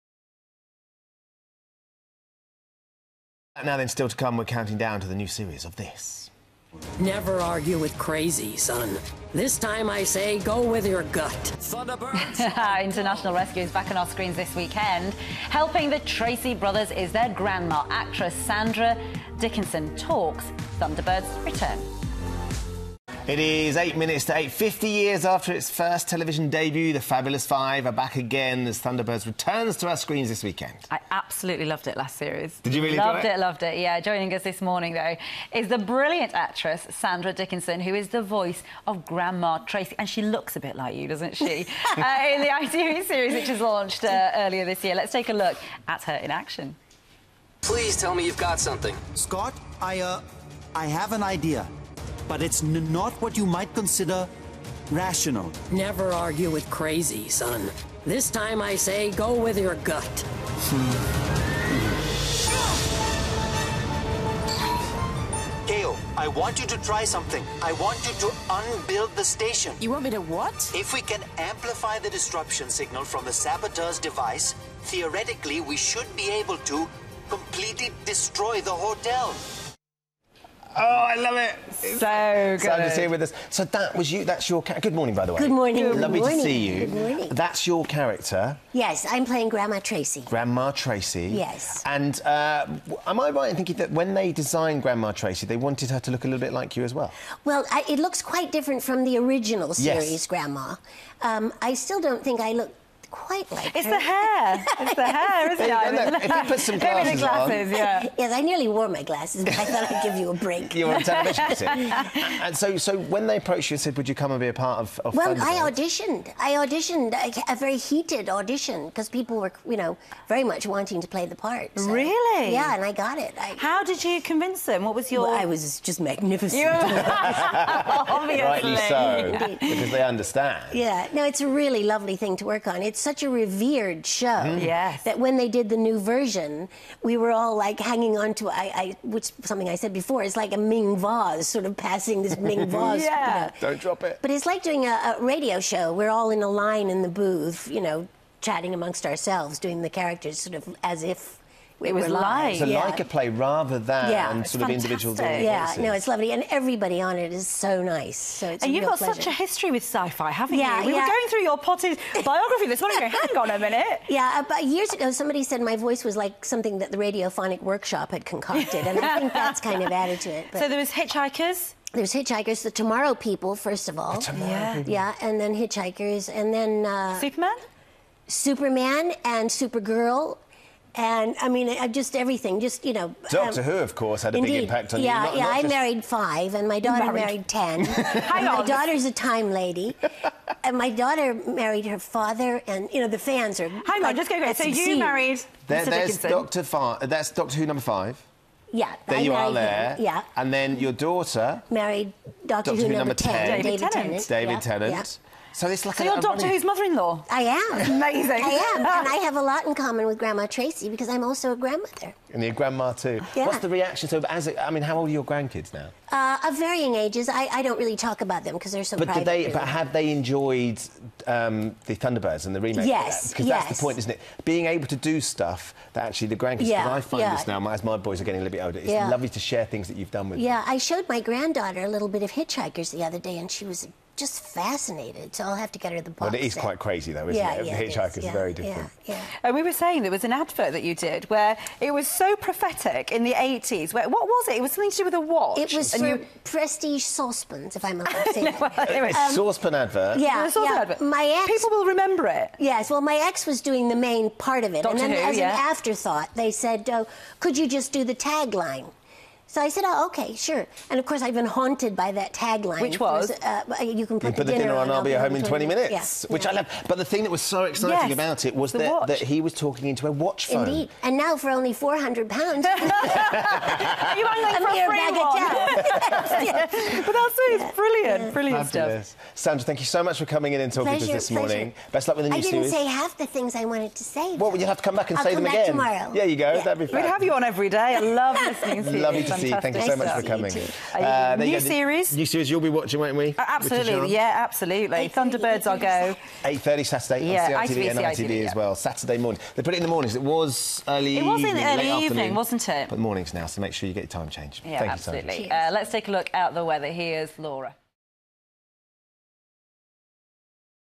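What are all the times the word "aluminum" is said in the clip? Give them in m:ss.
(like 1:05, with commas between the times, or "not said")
not said.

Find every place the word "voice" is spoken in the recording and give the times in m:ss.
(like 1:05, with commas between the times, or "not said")
0:38, 2:35, 2:45.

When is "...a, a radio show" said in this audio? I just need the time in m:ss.
2:24.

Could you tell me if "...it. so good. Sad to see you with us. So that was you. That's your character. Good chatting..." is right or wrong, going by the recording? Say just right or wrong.
wrong.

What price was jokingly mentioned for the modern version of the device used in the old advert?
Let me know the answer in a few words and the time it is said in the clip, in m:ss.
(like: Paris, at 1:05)
400 pounds, at 4:31.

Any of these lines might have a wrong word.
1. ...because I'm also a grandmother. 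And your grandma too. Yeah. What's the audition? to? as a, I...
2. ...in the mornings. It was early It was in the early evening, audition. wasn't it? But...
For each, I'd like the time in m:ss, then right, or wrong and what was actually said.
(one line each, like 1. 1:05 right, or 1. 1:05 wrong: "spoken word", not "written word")
1. 3:30 wrong: "reaction", not "audition"
2. 4:59 wrong: "afternoon", not "audition".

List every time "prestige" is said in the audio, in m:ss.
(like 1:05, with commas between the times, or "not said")
4:06.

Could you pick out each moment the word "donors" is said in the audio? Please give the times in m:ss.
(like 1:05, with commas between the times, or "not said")
not said.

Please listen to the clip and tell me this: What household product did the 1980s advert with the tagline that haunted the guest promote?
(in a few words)
Saucepans.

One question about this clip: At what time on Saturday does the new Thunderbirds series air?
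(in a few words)
8.30.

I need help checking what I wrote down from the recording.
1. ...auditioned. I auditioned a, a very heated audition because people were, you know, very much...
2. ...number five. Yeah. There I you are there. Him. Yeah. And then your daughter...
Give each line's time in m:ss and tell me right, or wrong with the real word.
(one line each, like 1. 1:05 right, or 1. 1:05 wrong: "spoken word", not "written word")
1. 1:55 right
2. 3:17 right.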